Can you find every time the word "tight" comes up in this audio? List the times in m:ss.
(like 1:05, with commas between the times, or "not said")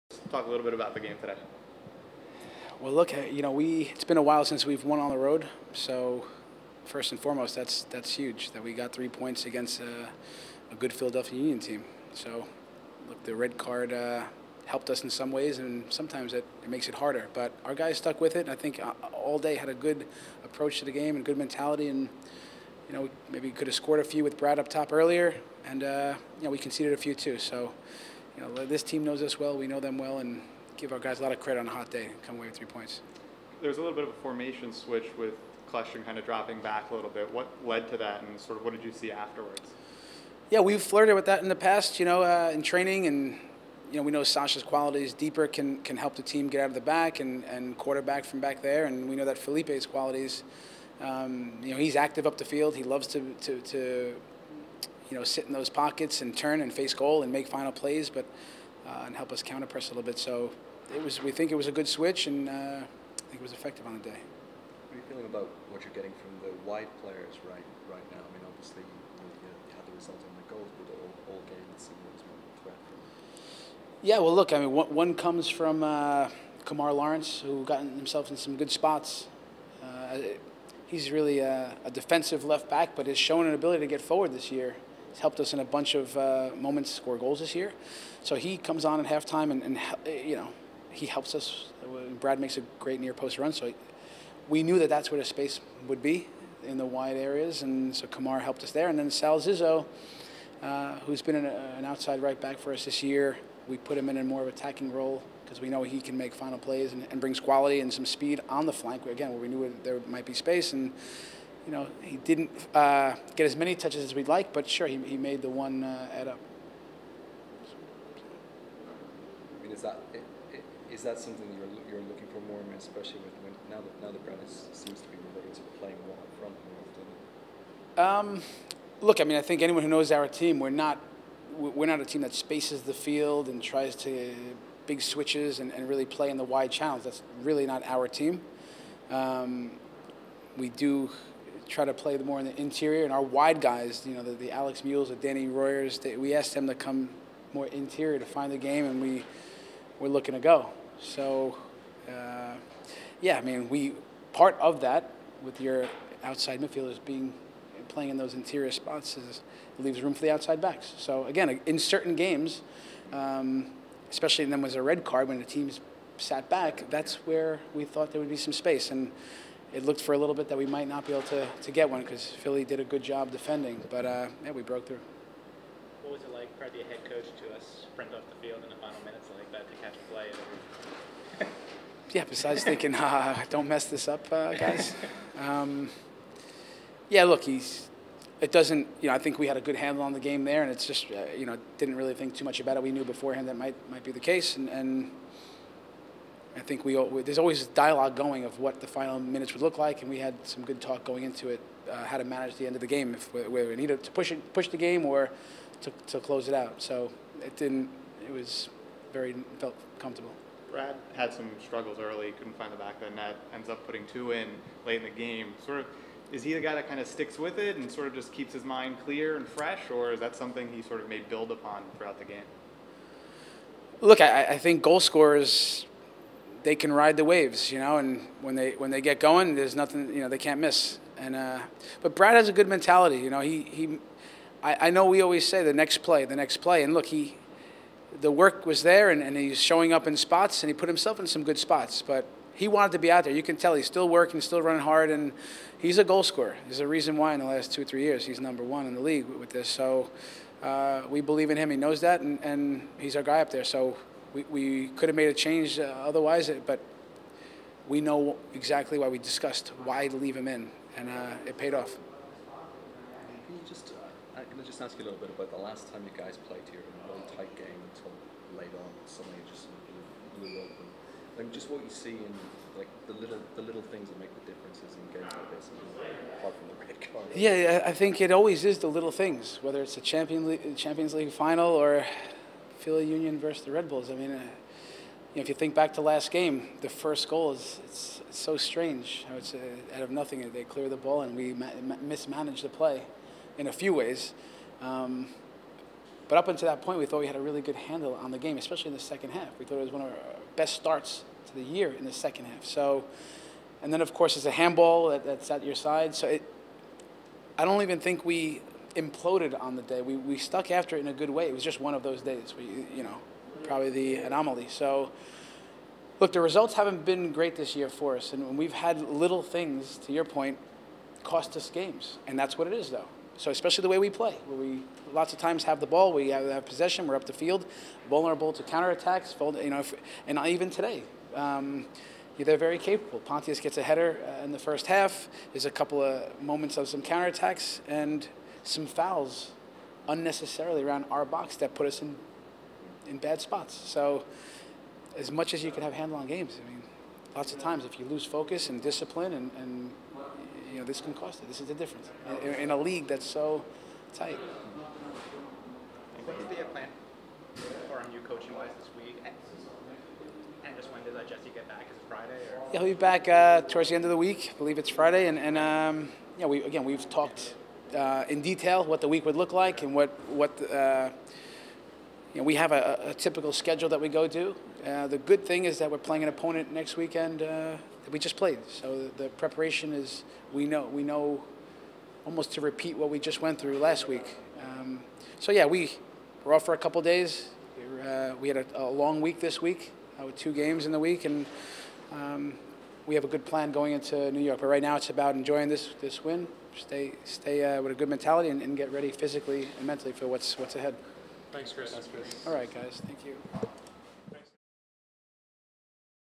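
4:27, 5:54.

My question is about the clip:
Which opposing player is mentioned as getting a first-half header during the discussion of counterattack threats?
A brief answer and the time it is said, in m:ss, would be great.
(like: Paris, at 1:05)
Pontius, at 5:33.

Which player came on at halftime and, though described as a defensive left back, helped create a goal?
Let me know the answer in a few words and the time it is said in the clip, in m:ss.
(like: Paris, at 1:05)
Kemar Lawrence, at 1:16.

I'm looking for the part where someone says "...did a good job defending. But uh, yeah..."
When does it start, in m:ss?
2:52.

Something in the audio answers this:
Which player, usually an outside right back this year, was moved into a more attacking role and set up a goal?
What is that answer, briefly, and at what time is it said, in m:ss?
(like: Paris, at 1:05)
Sal Zizzo, at 1:39.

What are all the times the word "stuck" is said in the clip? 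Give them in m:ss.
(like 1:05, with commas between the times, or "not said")
0:17, 5:10.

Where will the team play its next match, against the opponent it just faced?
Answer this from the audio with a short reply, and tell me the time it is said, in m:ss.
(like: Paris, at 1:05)
New York, at 6:34.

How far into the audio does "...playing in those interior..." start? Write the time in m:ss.
2:37.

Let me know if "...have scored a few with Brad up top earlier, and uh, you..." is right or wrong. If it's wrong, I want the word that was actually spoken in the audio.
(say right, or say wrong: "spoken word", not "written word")
right.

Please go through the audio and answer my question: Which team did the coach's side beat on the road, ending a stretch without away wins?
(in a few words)
Philadelphia Union.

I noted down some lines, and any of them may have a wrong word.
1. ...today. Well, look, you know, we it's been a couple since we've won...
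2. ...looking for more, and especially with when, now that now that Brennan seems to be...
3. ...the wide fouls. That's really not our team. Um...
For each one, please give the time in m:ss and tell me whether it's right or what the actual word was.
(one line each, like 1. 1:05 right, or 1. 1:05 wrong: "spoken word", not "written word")
1. 0:01 wrong: "while", not "couple"
2. 2:02 right
3. 2:16 wrong: "channels", not "fouls".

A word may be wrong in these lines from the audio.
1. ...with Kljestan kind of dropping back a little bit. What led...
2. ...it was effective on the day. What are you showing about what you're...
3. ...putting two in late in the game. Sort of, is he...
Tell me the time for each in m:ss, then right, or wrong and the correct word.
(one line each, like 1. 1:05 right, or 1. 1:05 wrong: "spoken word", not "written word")
1. 0:35 right
2. 1:03 wrong: "feeling", not "showing"
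3. 3:33 right.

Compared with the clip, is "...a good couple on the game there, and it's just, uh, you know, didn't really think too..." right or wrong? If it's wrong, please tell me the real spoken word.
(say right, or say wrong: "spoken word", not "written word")
wrong: "handle", not "couple".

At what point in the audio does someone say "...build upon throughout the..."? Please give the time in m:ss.
3:41.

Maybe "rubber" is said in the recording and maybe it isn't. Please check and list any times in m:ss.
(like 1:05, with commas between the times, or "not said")
not said.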